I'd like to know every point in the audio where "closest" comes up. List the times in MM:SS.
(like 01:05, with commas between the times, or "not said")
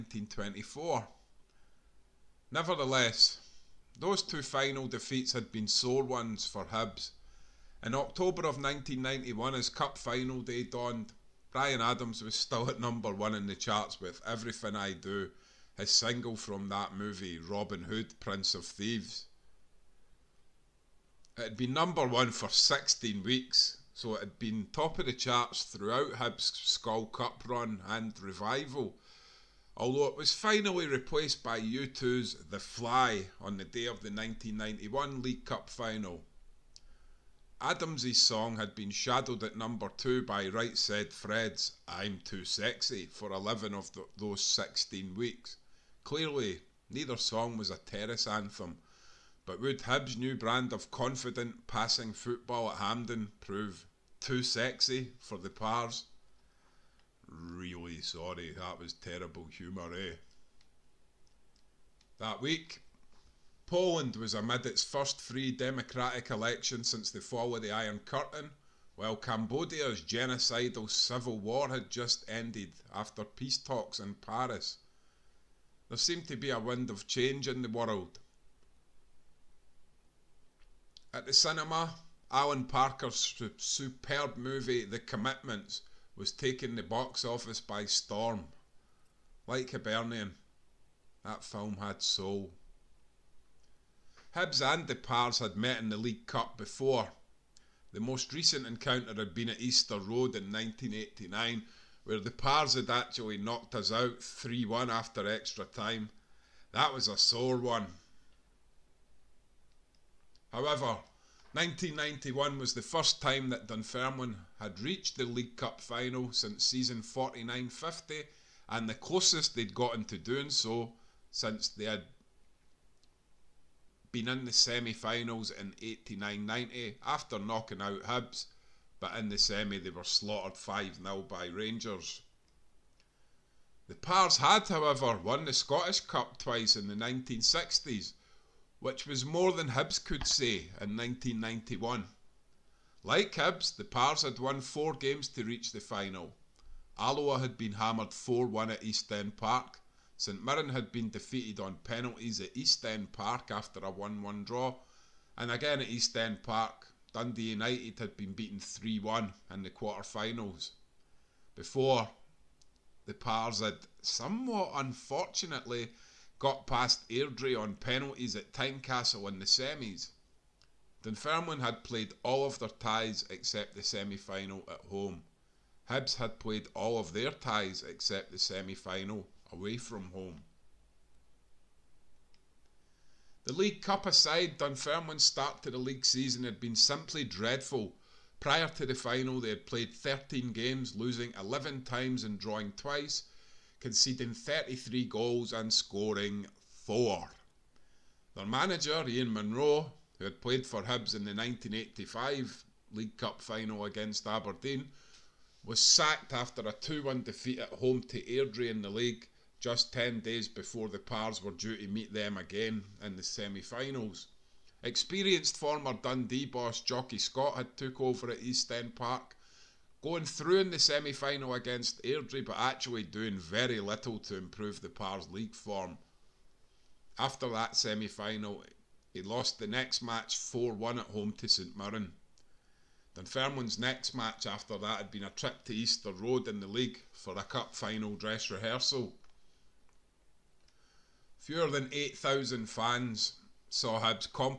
01:58.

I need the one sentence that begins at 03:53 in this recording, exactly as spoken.
Dunfermline's next match after that had been a trip to Easter Road in the league for a cup final dress rehearsal.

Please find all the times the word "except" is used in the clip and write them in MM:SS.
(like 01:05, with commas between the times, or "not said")
02:53, 02:57.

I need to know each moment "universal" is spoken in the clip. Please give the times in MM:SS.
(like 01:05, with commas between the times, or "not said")
not said.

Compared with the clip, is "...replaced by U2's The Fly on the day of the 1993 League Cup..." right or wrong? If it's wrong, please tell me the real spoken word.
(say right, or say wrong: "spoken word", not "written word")
wrong: "1991", not "1993".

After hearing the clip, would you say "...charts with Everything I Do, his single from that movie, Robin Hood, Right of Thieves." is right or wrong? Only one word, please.
wrong.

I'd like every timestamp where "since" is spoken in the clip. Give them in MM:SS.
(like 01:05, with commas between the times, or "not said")
01:06, 01:56, 02:01.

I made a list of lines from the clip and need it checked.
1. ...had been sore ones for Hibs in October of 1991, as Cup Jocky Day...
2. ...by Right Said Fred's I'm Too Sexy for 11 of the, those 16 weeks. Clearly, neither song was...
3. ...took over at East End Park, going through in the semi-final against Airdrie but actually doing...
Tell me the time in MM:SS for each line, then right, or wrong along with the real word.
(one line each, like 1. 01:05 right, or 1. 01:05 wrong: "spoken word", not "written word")
1. 00:05 wrong: "Final", not "Jocky"
2. 00:40 right
3. 03:37 right.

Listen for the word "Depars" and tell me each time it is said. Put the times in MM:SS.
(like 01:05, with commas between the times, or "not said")
01:34, 01:42.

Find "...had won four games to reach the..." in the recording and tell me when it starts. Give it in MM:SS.
02:24.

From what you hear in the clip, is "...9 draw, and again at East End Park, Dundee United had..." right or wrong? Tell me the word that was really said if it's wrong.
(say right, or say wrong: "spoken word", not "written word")
wrong: "1", not "9".